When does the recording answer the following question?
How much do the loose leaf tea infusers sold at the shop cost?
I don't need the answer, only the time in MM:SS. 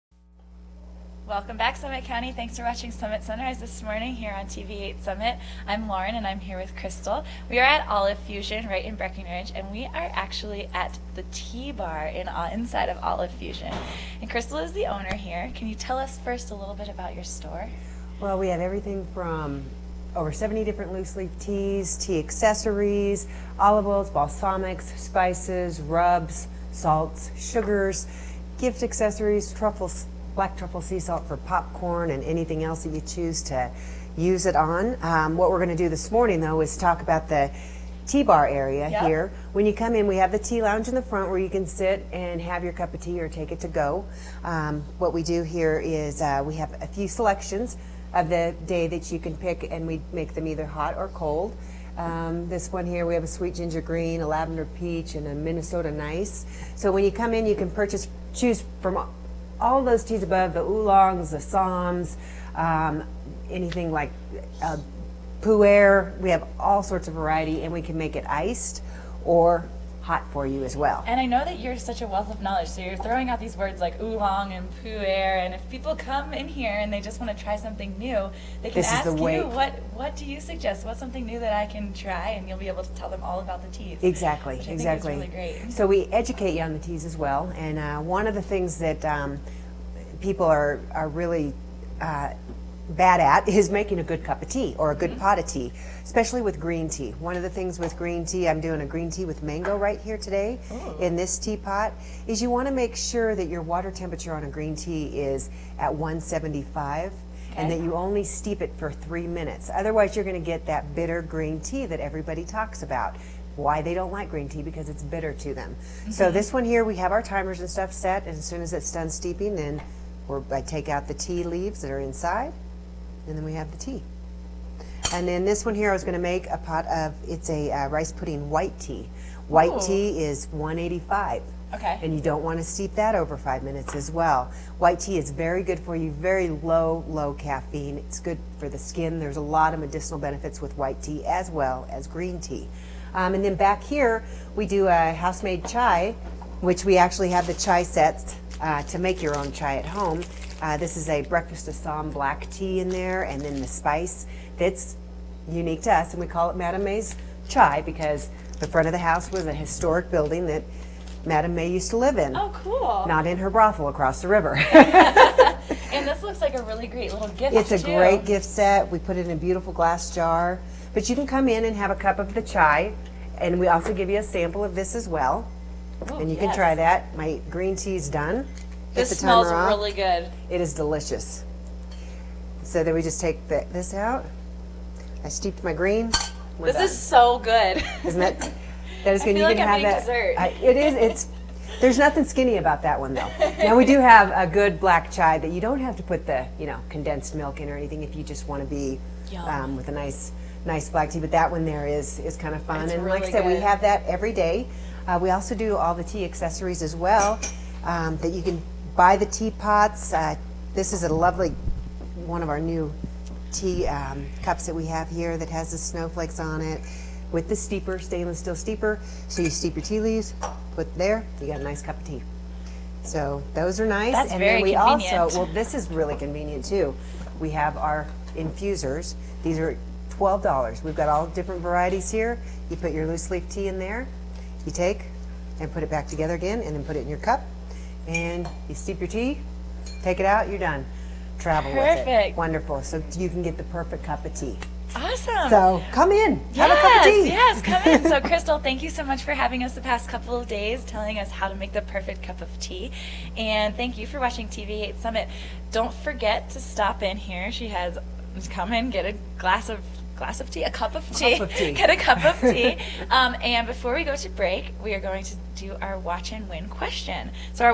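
03:50.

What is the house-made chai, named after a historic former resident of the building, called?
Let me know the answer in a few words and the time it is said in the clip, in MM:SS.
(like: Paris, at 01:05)
Madame May's chai, at 02:36.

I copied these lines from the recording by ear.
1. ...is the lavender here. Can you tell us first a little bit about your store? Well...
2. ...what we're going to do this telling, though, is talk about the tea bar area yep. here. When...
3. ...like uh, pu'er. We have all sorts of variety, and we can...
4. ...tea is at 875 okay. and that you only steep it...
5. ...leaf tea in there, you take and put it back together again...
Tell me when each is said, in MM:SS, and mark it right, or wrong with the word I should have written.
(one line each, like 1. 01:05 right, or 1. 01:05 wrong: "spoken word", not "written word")
1. 00:14 wrong: "owner", not "lavender"
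2. 00:35 wrong: "morning", not "telling"
3. 01:03 right
4. 01:44 wrong: "175", not "875"
5. 03:53 right.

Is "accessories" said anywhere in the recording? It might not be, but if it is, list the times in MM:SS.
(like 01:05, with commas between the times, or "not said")
00:22, 00:28, 03:26.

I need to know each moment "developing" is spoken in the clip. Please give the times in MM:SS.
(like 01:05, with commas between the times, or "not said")
not said.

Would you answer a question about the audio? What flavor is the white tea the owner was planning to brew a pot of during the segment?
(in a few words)
rice pudding.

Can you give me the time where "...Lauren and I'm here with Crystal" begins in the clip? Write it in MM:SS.
00:05.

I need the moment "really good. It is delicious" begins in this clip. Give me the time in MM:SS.
02:59.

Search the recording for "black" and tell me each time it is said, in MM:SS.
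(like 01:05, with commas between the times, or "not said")
00:30, 02:32, 03:14, 03:20.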